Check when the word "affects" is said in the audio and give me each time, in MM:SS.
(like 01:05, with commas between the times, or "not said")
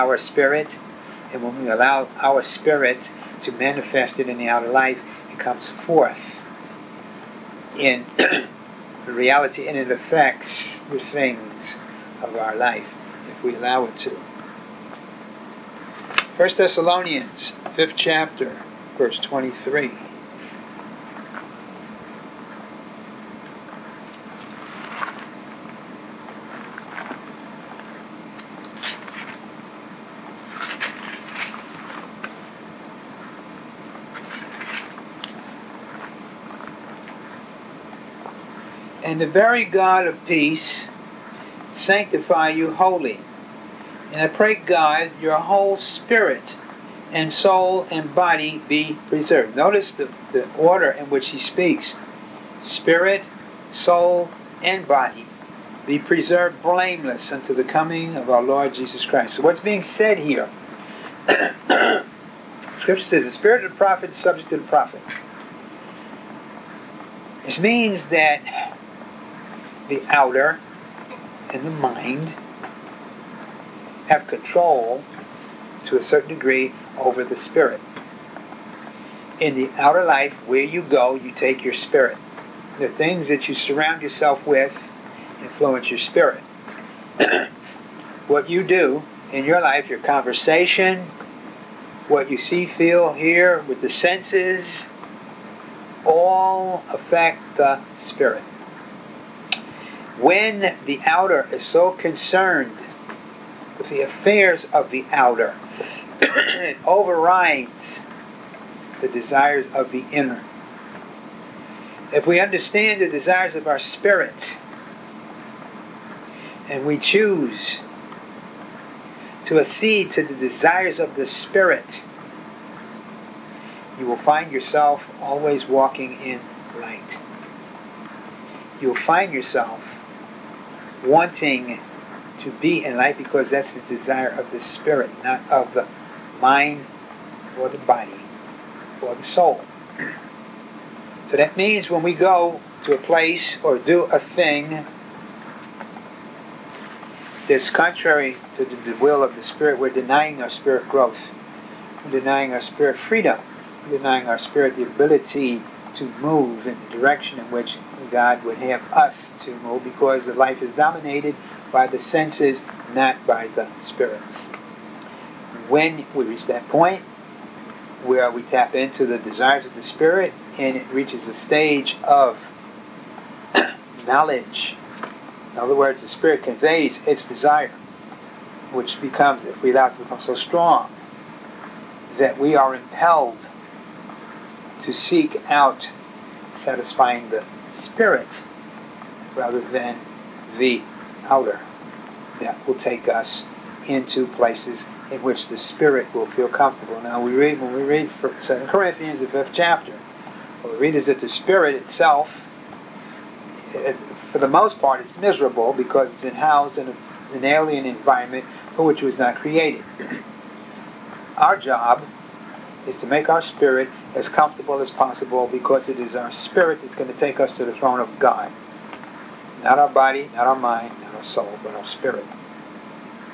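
00:09, 01:36.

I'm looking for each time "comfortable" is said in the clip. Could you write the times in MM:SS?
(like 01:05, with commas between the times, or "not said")
03:16, 03:34.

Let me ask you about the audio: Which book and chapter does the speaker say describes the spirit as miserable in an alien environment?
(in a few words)
2 Corinthians 5.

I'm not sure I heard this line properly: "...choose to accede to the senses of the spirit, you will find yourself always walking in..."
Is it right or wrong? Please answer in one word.
wrong.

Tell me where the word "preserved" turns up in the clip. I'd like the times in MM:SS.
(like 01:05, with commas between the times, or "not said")
00:49, 00:55.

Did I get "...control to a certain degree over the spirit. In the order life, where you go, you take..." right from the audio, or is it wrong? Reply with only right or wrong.
wrong.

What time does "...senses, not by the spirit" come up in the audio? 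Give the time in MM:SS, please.
02:41.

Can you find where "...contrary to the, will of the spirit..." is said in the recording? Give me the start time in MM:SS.
02:27.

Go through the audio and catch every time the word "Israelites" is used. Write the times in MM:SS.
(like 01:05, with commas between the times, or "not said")
not said.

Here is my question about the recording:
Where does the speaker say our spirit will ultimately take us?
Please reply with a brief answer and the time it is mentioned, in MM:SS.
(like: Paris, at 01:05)
The throne of God, at 03:37.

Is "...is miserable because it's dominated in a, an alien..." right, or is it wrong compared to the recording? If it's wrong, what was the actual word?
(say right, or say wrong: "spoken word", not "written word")
wrong: "housed", not "dominated".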